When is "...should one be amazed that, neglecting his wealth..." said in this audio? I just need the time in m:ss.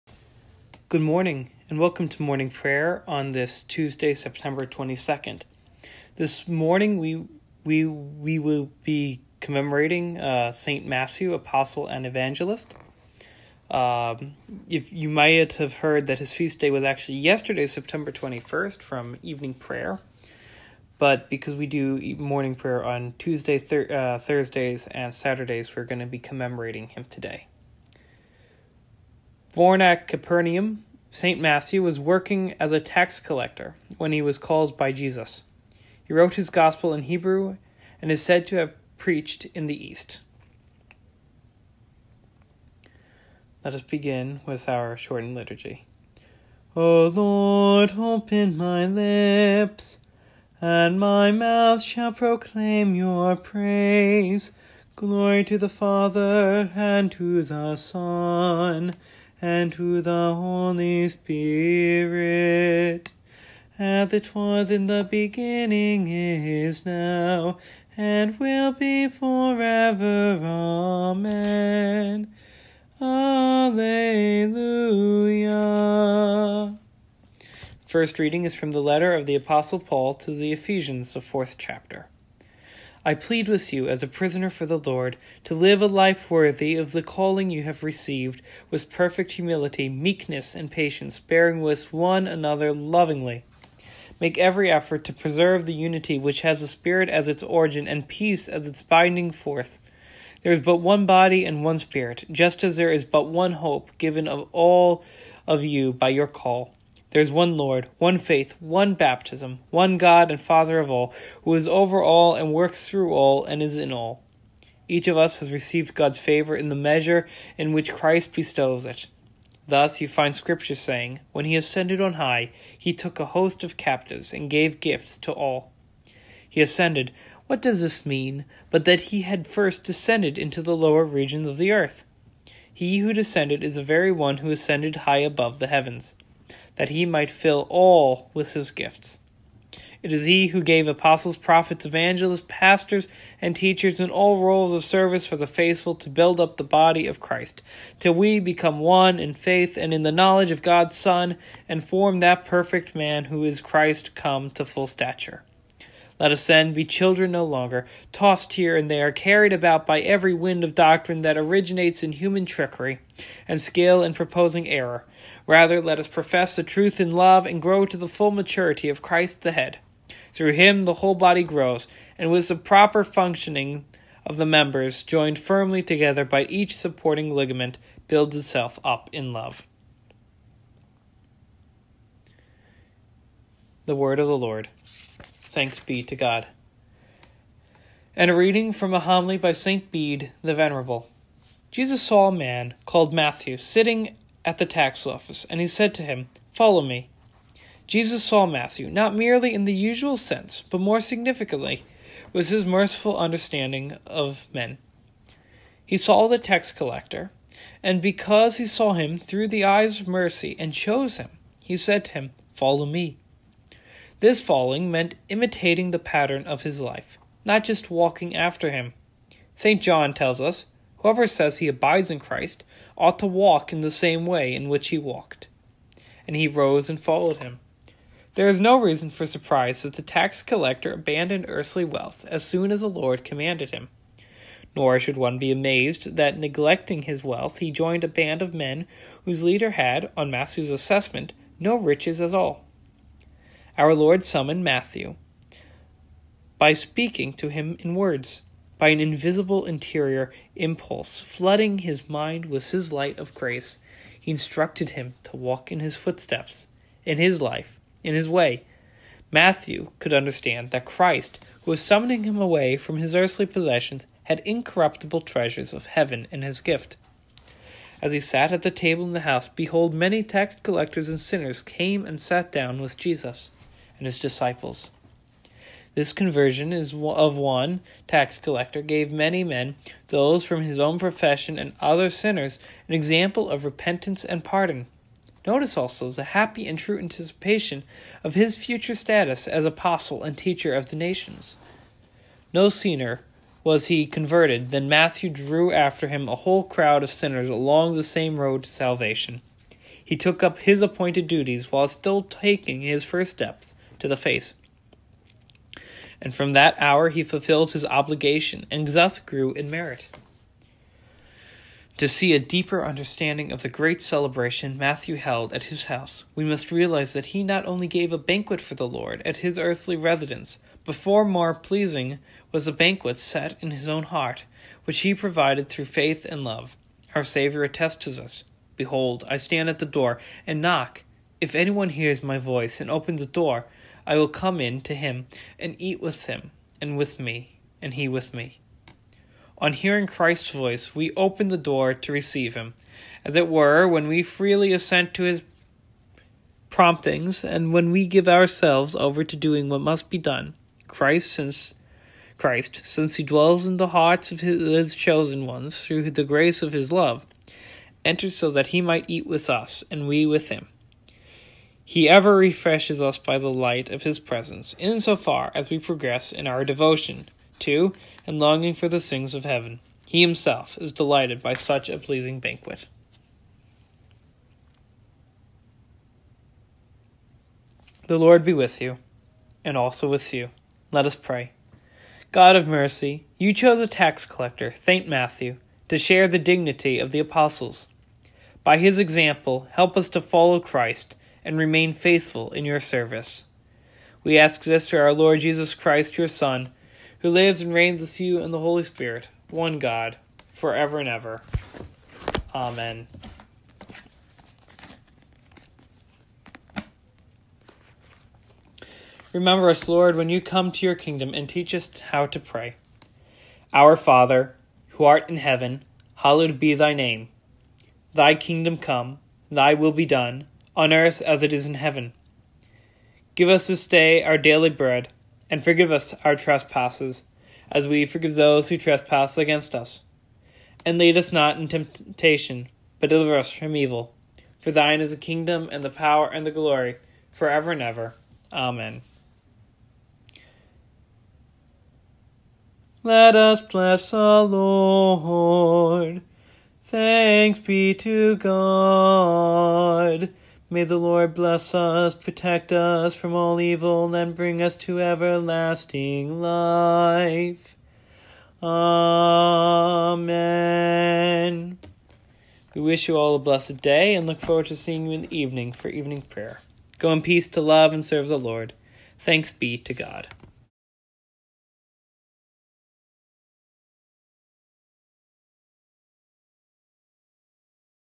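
3:54.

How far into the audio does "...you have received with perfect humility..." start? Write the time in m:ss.
1:27.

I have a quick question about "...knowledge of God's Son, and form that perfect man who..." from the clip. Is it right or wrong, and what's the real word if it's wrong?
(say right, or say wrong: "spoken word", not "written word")
right.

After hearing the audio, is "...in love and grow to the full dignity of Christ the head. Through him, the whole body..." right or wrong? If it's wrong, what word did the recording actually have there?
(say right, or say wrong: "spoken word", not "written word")
wrong: "maturity", not "dignity".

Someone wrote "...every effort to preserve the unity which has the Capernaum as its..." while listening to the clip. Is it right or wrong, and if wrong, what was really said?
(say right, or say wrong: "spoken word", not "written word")
wrong: "Spirit", not "Capernaum".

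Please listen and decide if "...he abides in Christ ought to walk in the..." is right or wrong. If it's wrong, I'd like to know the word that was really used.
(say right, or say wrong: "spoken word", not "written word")
right.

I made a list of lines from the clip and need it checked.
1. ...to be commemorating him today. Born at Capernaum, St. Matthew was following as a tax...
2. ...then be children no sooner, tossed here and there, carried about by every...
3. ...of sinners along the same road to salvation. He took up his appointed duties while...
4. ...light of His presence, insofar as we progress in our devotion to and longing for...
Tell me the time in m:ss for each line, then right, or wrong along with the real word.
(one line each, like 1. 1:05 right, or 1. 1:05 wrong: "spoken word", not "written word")
1. 0:25 wrong: "working", not "following"
2. 2:36 wrong: "longer", not "sooner"
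3. 4:57 right
4. 6:03 right.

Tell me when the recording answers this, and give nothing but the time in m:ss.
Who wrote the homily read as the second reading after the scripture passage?
3:09.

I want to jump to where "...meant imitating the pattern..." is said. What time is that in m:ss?
3:34.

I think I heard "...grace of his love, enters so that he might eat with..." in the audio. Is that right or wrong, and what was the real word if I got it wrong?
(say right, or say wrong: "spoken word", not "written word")
right.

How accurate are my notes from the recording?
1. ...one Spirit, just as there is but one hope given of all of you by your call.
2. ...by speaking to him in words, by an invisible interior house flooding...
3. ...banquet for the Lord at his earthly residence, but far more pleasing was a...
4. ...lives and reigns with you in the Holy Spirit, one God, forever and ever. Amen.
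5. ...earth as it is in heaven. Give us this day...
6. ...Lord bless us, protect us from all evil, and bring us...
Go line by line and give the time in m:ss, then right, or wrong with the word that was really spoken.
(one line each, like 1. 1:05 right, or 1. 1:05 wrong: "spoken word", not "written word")
1. 1:41 right
2. 4:06 wrong: "impulse", not "house"
3. 5:18 right
4. 6:37 right
5. 7:00 right
6. 7:30 right.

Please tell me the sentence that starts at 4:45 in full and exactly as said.
Notice also the happy and true anticipation of his future status as apostle and teacher of the nations.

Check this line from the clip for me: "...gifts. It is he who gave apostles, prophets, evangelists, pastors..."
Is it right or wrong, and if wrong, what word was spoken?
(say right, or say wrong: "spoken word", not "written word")
right.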